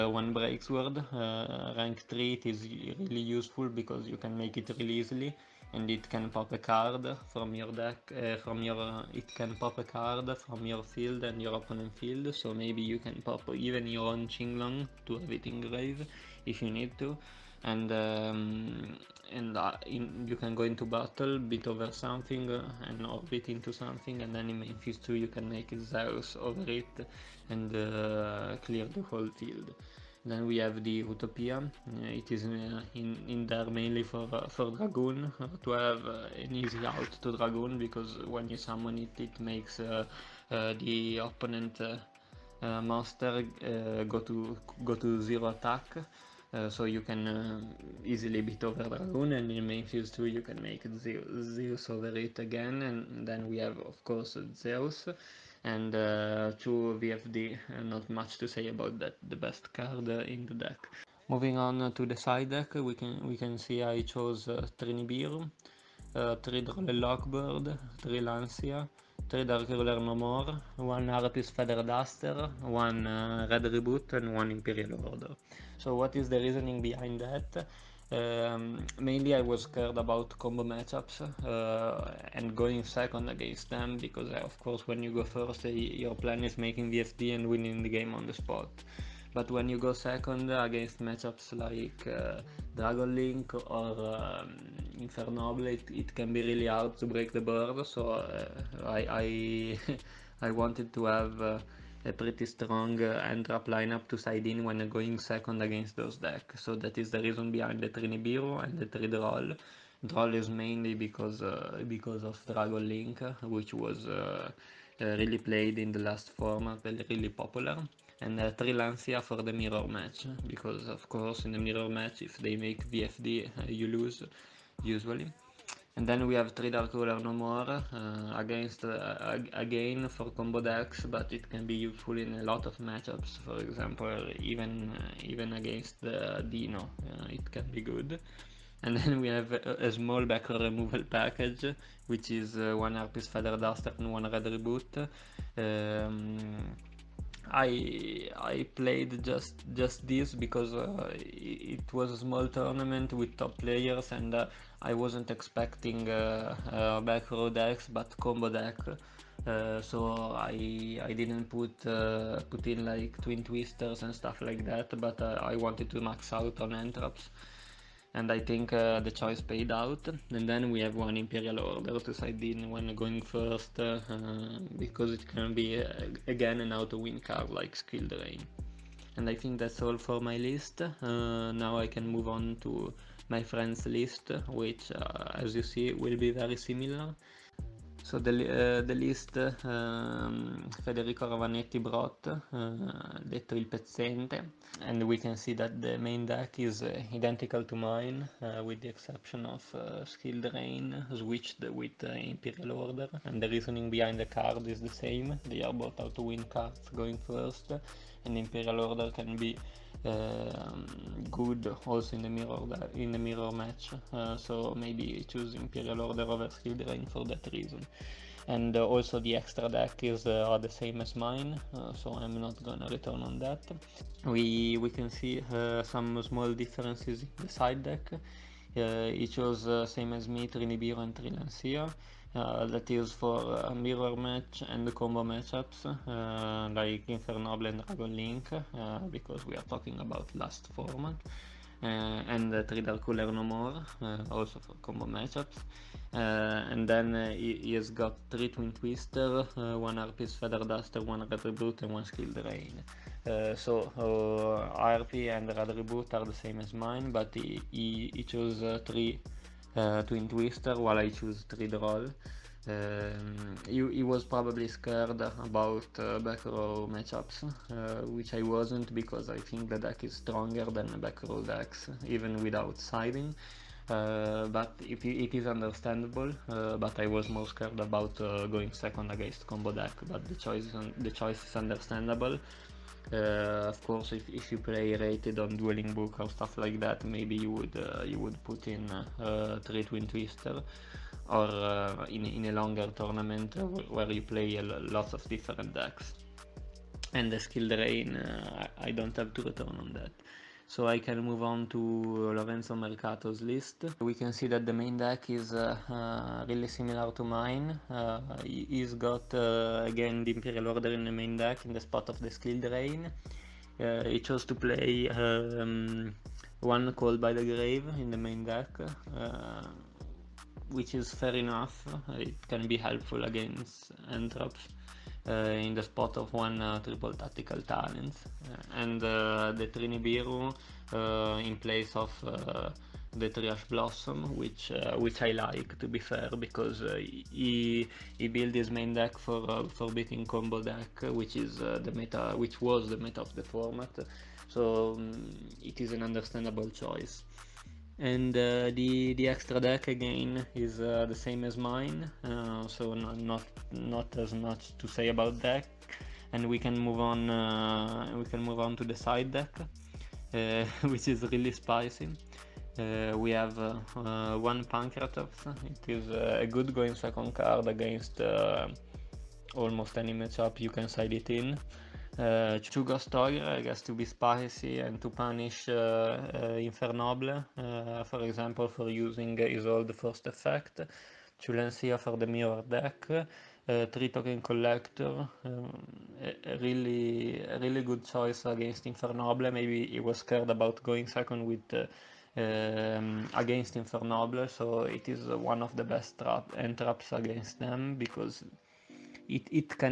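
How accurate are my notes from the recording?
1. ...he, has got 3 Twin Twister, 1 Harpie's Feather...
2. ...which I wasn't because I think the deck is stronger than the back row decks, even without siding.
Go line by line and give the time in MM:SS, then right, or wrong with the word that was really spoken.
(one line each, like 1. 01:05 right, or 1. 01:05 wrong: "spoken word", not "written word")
1. 04:07 right
2. 04:28 right.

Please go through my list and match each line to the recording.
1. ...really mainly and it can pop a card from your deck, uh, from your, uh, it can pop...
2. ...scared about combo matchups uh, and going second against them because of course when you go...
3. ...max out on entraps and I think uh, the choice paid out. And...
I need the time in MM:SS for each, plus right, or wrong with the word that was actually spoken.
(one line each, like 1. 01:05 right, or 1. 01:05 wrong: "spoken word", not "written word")
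1. 00:04 wrong: "easily", not "mainly"
2. 01:19 right
3. 02:46 right.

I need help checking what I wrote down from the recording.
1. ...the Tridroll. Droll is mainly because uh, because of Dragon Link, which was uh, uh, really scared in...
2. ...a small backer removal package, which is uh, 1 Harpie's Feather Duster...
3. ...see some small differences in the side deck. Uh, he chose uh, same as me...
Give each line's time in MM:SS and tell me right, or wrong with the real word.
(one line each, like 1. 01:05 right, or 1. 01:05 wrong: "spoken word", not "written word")
1. 01:48 wrong: "played", not "scared"
2. 02:19 right
3. 03:45 right.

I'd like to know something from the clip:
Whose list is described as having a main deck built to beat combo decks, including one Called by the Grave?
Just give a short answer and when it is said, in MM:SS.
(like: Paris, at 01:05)
Lorenzo Marcato, at 05:02.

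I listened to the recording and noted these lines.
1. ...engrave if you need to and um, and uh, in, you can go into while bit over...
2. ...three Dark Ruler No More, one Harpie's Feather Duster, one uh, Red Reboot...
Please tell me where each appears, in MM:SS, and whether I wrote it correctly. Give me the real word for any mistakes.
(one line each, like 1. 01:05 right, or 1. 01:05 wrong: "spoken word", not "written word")
1. 00:15 wrong: "battle", not "while"
2. 01:09 right.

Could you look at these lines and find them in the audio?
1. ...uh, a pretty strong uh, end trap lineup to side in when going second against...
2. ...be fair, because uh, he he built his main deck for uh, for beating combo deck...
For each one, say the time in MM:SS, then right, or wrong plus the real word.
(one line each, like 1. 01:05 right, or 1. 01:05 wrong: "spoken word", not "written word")
1. 01:41 right
2. 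05:35 right.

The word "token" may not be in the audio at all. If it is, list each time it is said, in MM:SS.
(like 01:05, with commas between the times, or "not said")
06:24.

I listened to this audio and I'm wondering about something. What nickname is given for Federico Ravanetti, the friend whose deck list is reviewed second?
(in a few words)
il pezzente.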